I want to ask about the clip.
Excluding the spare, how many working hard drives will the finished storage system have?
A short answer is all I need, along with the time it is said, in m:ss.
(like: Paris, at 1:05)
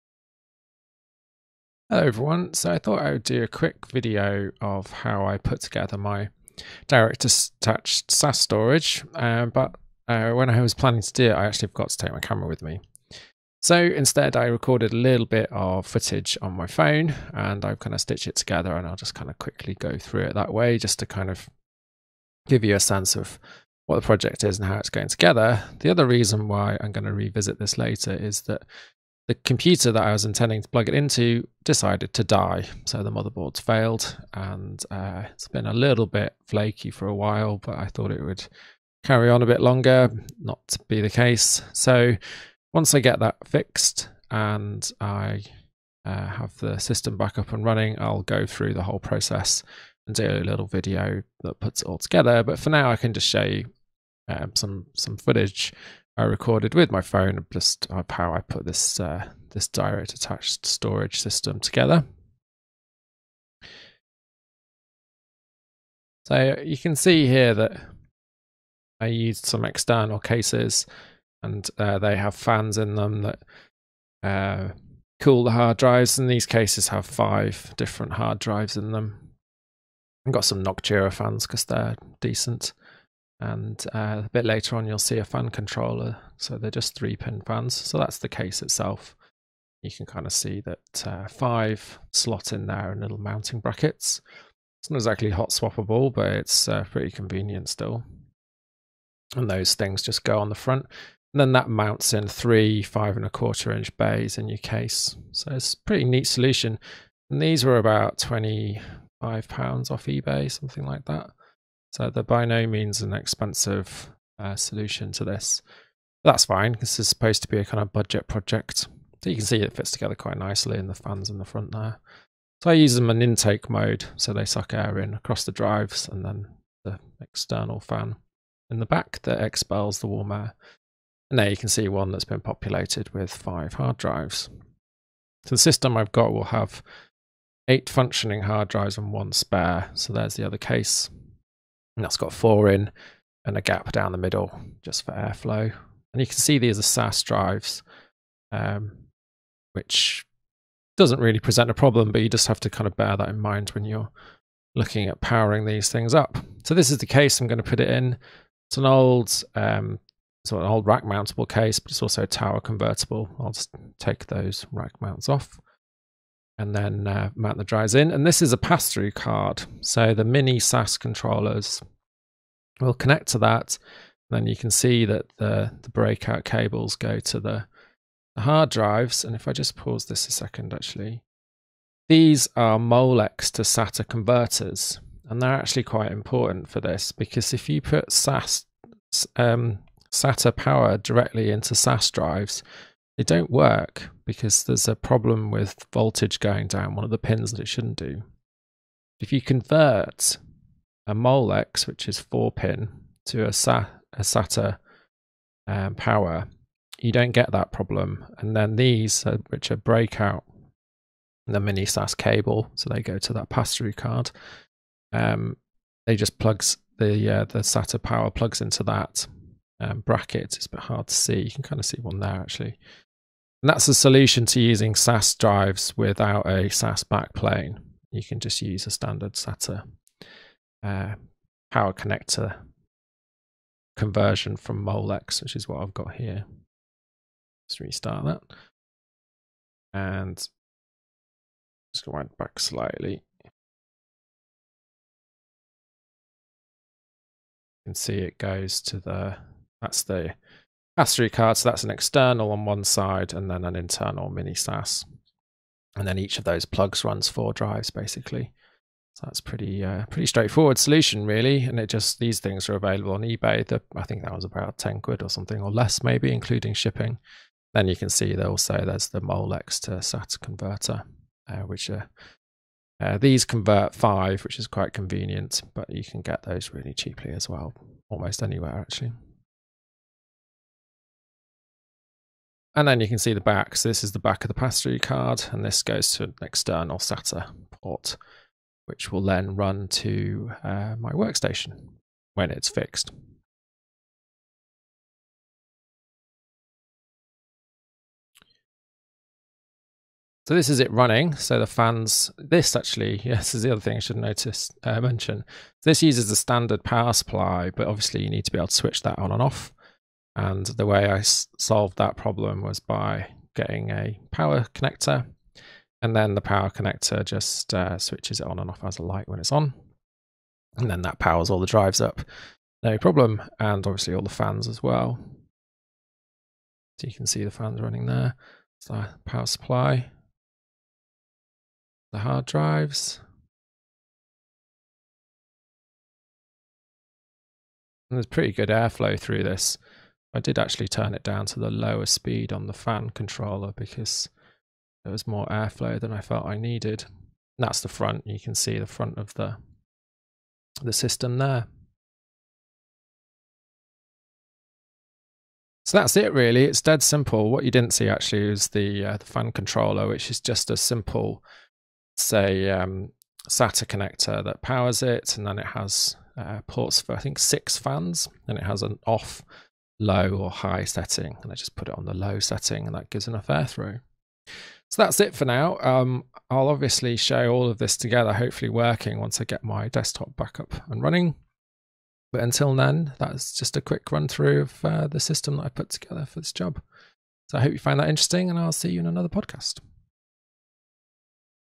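8, at 2:17.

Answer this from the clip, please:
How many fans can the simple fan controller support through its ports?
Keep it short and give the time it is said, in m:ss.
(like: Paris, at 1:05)
6, at 6:07.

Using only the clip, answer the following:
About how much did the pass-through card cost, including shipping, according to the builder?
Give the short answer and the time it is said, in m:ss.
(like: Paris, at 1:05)
ten quid, at 4:24.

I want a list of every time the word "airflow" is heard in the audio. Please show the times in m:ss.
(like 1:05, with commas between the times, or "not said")
2:25, 5:38, 5:45.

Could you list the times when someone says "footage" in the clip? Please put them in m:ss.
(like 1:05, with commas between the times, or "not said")
0:15, 0:55.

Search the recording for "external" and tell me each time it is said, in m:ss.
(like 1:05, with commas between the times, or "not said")
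1:09, 2:07, 4:11, 4:46.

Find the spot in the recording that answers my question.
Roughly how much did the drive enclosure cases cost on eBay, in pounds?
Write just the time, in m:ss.
1:48.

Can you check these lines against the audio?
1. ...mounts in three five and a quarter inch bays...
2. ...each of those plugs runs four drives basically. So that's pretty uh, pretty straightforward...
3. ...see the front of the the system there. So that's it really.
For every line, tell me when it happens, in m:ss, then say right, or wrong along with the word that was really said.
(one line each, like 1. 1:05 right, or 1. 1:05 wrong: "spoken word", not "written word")
1. 1:41 right
2. 4:16 right
3. 5:48 right.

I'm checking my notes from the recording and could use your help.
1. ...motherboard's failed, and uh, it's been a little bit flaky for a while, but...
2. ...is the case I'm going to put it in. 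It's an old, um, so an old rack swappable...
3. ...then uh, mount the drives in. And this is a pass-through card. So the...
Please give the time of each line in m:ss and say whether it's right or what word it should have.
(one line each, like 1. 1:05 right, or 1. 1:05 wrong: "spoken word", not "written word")
1. 0:33 right
2. 2:36 wrong: "mountable", not "swappable"
3. 2:46 right.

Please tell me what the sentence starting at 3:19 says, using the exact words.
If you convert a Molex, which is 4 pin, to a, a SATA um, power, you don't get that problem.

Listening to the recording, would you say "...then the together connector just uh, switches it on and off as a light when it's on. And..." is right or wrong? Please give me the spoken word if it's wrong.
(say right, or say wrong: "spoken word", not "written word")
wrong: "power", not "together".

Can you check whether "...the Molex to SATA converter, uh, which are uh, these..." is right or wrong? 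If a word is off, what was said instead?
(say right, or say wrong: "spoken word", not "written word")
right.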